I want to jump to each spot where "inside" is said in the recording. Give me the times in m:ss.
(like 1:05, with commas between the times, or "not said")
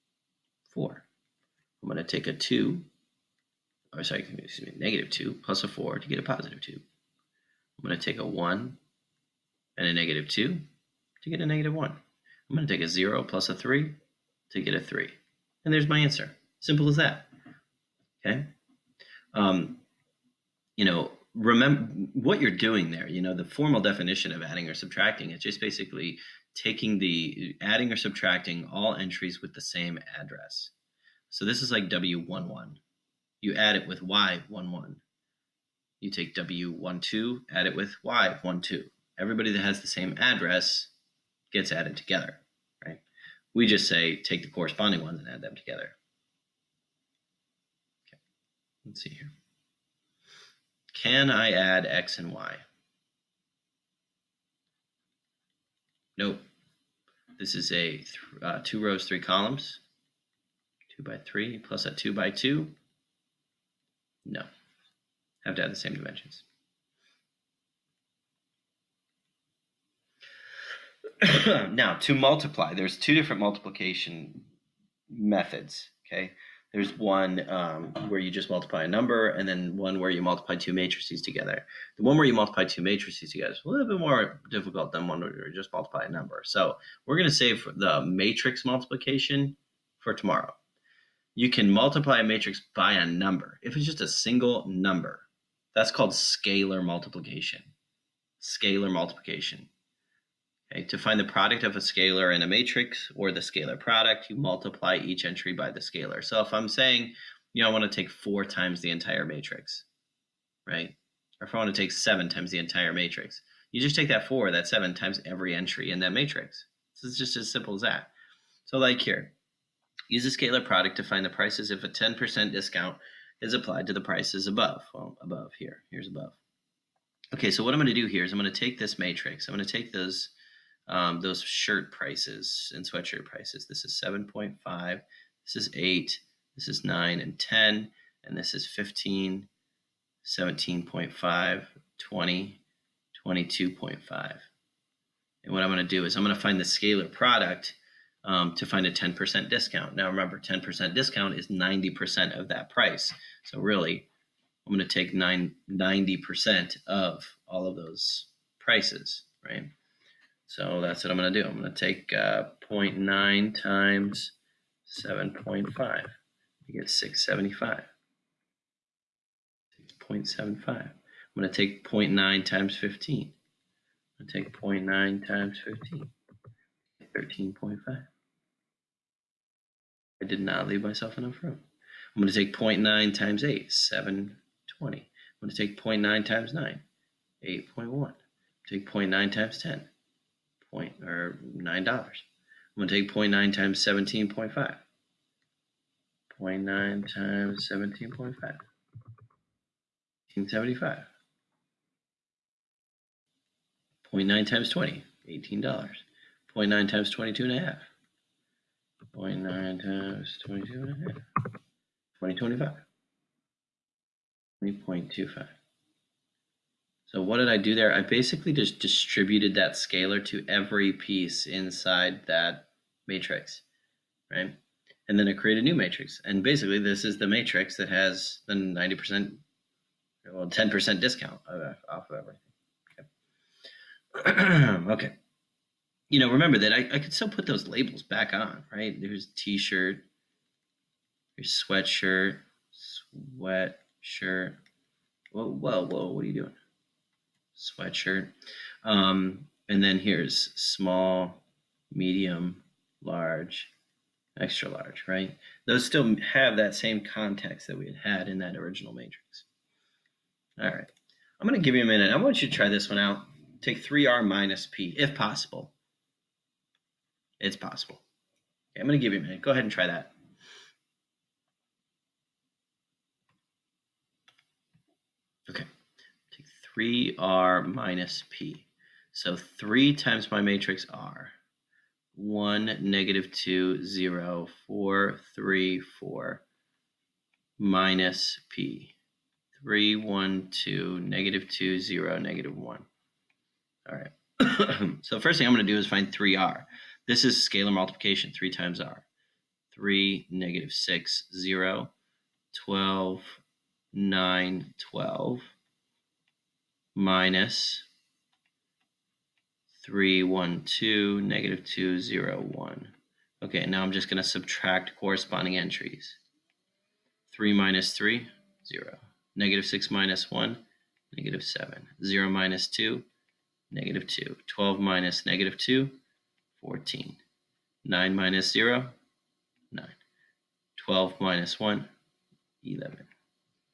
3:41.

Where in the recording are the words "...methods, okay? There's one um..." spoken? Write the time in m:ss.
1:15.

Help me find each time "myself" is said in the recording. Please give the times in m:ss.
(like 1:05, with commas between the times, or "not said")
3:00.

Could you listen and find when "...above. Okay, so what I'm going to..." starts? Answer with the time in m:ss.
2:06.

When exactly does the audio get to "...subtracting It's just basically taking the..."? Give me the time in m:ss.
0:24.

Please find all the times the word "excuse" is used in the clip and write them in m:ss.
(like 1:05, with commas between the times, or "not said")
0:04.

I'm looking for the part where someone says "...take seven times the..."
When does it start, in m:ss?
1:51.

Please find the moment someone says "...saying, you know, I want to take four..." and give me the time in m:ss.
1:46.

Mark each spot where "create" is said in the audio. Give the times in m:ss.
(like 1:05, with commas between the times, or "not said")
3:45.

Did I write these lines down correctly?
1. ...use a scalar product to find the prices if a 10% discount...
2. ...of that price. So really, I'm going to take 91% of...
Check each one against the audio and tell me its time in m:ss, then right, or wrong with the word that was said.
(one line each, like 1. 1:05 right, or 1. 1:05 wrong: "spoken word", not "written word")
1. 2:00 right
2. 2:32 wrong: "90", not "91".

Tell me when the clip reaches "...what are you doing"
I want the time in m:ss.
4:06.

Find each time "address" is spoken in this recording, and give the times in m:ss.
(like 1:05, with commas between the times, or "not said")
0:30, 0:40.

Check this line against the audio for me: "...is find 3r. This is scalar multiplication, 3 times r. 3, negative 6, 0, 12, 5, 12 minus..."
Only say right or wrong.
wrong.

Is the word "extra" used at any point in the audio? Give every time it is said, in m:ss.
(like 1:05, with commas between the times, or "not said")
4:14.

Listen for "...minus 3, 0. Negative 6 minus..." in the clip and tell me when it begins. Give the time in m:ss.
5:17.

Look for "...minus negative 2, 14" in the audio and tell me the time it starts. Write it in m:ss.
5:24.